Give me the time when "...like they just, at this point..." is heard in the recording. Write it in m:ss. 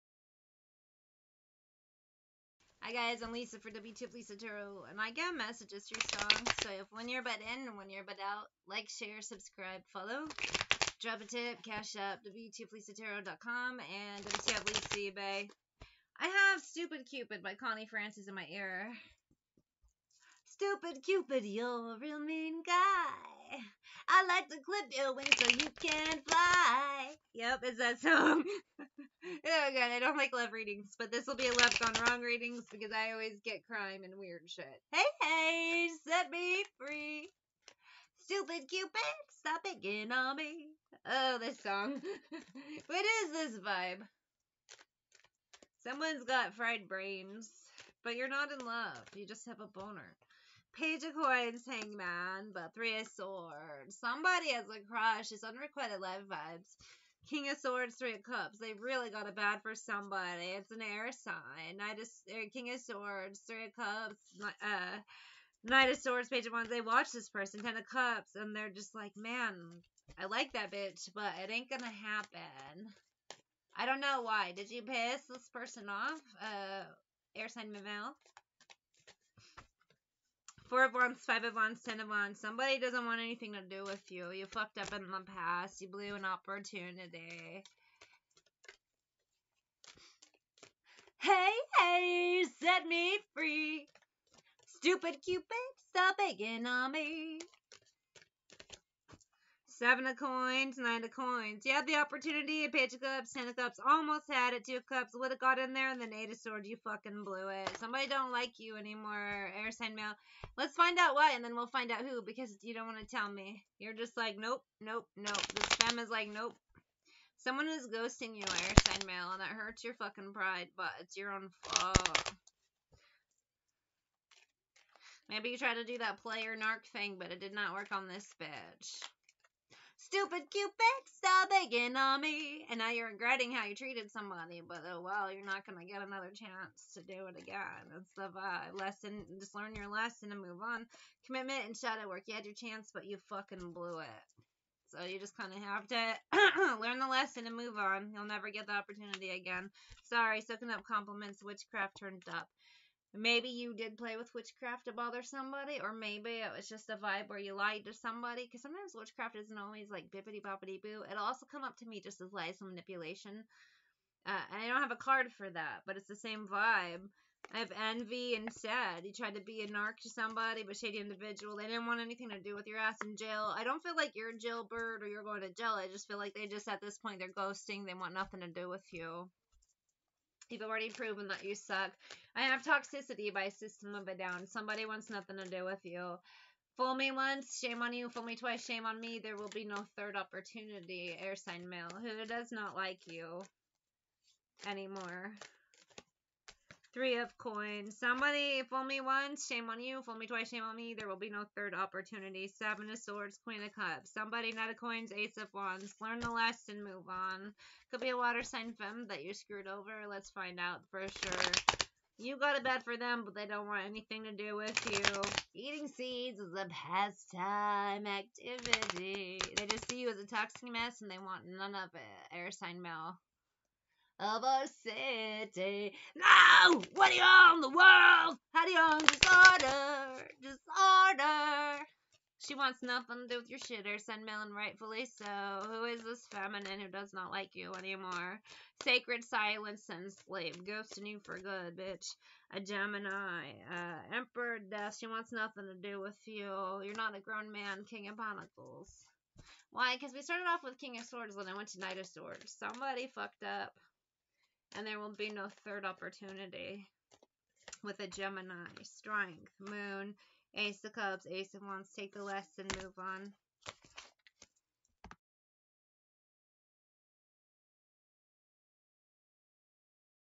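2:56.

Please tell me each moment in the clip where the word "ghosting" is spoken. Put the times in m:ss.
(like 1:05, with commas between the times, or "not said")
1:57, 2:57, 4:00.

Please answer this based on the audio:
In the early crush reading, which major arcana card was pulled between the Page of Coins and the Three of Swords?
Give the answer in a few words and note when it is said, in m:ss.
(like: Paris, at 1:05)
Hanged Man, at 0:51.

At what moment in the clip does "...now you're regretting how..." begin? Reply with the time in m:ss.
2:12.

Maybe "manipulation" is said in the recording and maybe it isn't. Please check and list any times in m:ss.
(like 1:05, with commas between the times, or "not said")
2:42.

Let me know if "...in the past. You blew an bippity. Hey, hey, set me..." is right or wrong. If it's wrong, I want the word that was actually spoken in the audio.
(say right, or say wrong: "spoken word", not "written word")
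wrong: "opportunity", not "bippity".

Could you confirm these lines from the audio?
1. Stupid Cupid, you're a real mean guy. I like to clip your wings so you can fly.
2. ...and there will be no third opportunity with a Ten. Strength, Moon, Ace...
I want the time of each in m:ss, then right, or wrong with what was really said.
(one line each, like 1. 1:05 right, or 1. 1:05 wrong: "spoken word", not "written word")
1. 0:20 right
2. 4:14 wrong: "Gemini", not "Ten".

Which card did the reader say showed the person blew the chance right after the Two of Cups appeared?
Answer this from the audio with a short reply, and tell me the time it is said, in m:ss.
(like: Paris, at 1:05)
Eight of Swords, at 1:46.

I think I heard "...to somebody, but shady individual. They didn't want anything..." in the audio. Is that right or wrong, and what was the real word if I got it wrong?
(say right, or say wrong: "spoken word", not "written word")
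right.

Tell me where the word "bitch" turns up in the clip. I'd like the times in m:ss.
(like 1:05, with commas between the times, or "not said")
1:10, 2:08, 4:01.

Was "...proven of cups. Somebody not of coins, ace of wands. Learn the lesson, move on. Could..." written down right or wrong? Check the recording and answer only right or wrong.
wrong.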